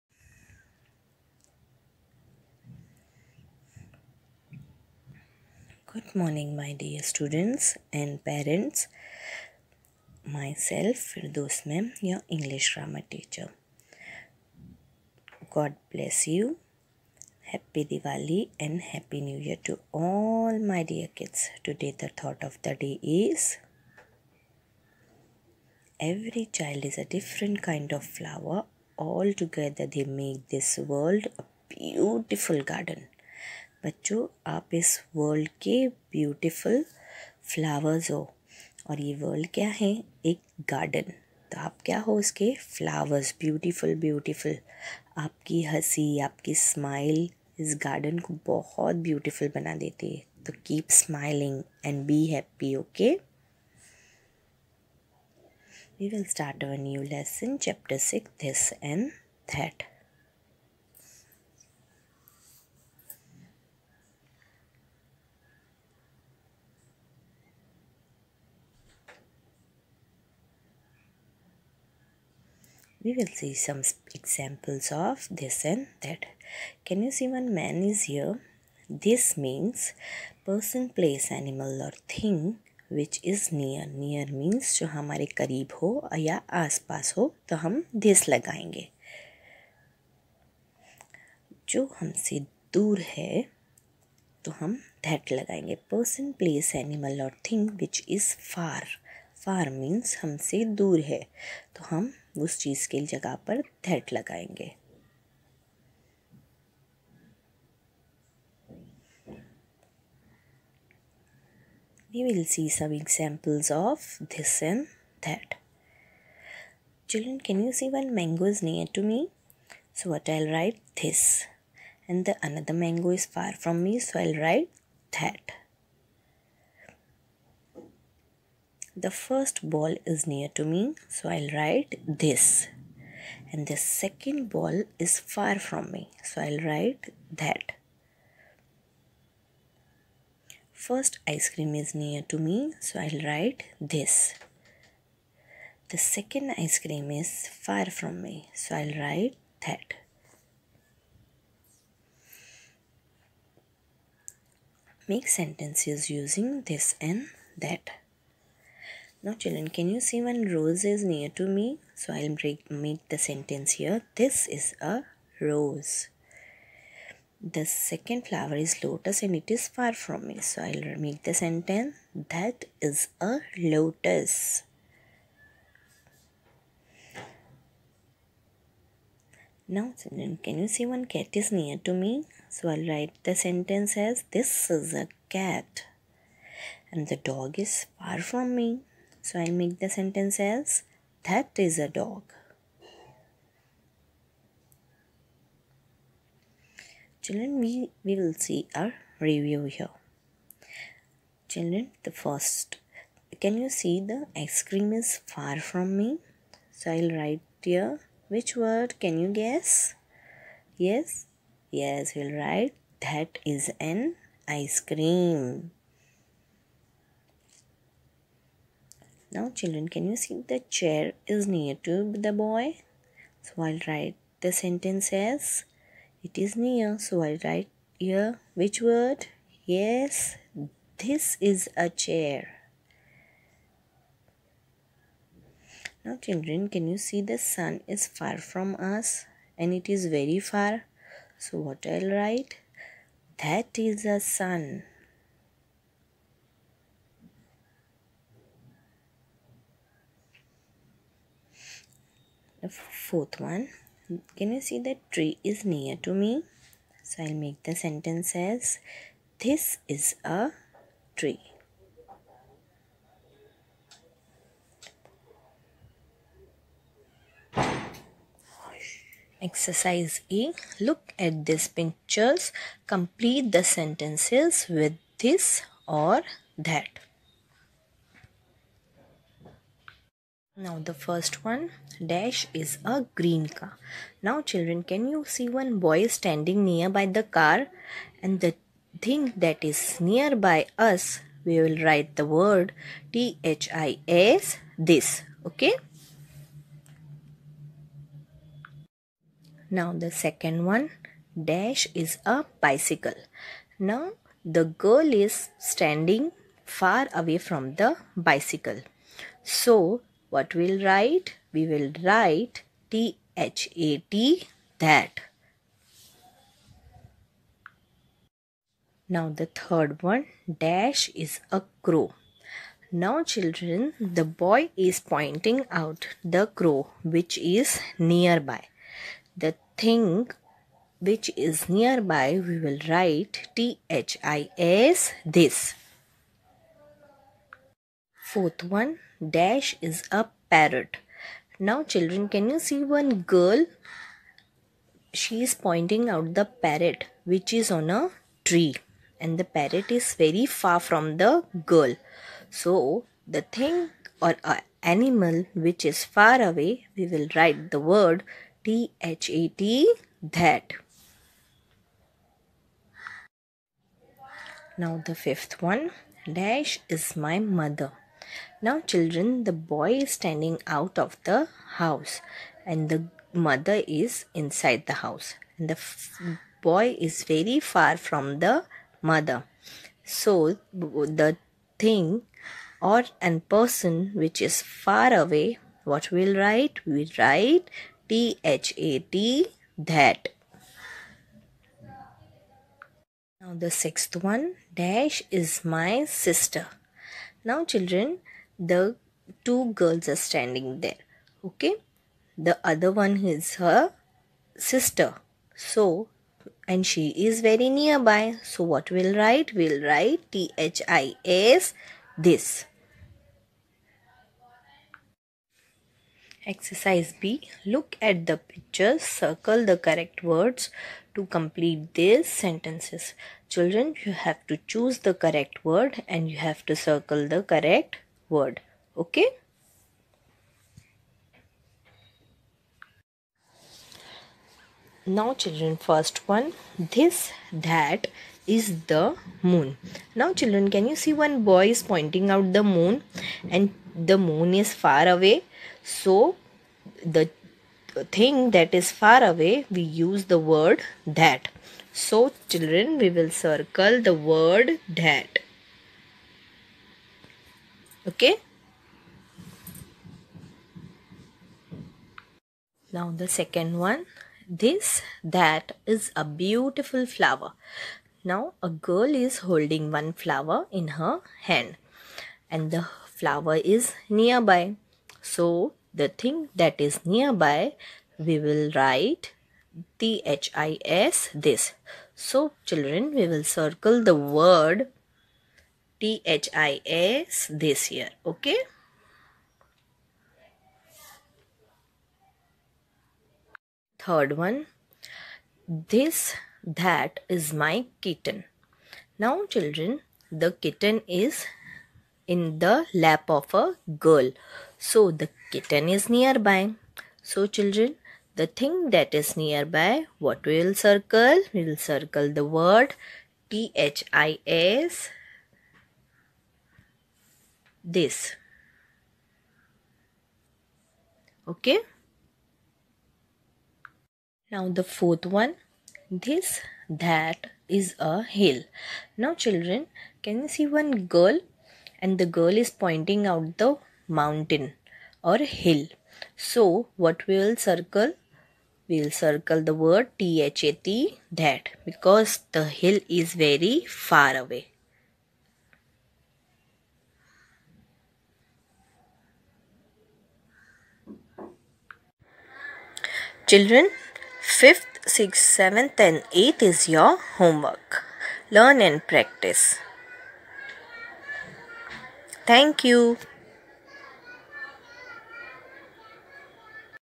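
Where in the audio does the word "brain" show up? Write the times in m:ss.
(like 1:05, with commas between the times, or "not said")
not said.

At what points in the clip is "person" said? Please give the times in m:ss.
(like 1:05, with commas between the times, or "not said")
1:20, 1:35, 6:23.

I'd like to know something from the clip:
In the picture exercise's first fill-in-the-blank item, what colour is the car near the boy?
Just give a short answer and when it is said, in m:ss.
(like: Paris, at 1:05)
green, at 4:43.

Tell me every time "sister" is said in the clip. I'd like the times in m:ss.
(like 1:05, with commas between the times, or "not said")
6:36, 6:44.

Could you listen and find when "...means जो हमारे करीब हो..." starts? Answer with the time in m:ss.
1:24.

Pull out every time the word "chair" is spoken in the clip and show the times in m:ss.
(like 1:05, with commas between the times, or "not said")
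3:40, 3:51.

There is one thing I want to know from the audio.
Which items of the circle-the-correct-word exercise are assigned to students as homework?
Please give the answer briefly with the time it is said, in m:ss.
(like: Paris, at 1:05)
5th, 6th, 7th and 8th, at 9:14.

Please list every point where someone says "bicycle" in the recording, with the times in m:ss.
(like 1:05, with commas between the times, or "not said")
5:02, 5:08.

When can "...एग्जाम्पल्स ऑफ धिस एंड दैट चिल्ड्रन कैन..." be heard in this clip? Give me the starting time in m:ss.
1:52.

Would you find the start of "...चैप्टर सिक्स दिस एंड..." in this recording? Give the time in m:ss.
0:57.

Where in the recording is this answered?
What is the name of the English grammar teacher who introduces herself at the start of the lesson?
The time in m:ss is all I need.
0:11.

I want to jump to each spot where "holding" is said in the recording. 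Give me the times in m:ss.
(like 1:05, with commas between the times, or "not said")
7:49.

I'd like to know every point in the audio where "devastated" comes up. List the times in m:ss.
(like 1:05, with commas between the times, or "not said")
not said.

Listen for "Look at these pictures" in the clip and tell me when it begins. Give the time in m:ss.
4:30.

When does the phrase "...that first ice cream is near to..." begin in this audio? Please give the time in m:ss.
2:17.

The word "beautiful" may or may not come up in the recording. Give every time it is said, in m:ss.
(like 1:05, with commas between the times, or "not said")
0:31, 7:46.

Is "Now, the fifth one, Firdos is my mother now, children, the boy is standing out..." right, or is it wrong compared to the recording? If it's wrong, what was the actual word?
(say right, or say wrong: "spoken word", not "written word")
wrong: "Dash", not "Firdos".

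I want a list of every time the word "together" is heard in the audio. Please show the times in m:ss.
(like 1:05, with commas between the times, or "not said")
0:29.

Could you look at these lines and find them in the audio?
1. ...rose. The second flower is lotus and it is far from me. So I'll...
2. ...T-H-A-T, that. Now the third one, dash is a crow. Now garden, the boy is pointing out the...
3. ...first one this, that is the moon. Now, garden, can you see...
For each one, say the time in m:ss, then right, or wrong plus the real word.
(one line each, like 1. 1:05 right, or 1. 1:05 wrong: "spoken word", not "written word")
1. 2:45 right
2. 5:12 wrong: "children", not "garden"
3. 7:15 wrong: "children", not "garden".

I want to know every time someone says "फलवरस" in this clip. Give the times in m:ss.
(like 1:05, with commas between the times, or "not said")
0:37, 0:42.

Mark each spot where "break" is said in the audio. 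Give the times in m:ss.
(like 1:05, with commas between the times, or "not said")
2:42.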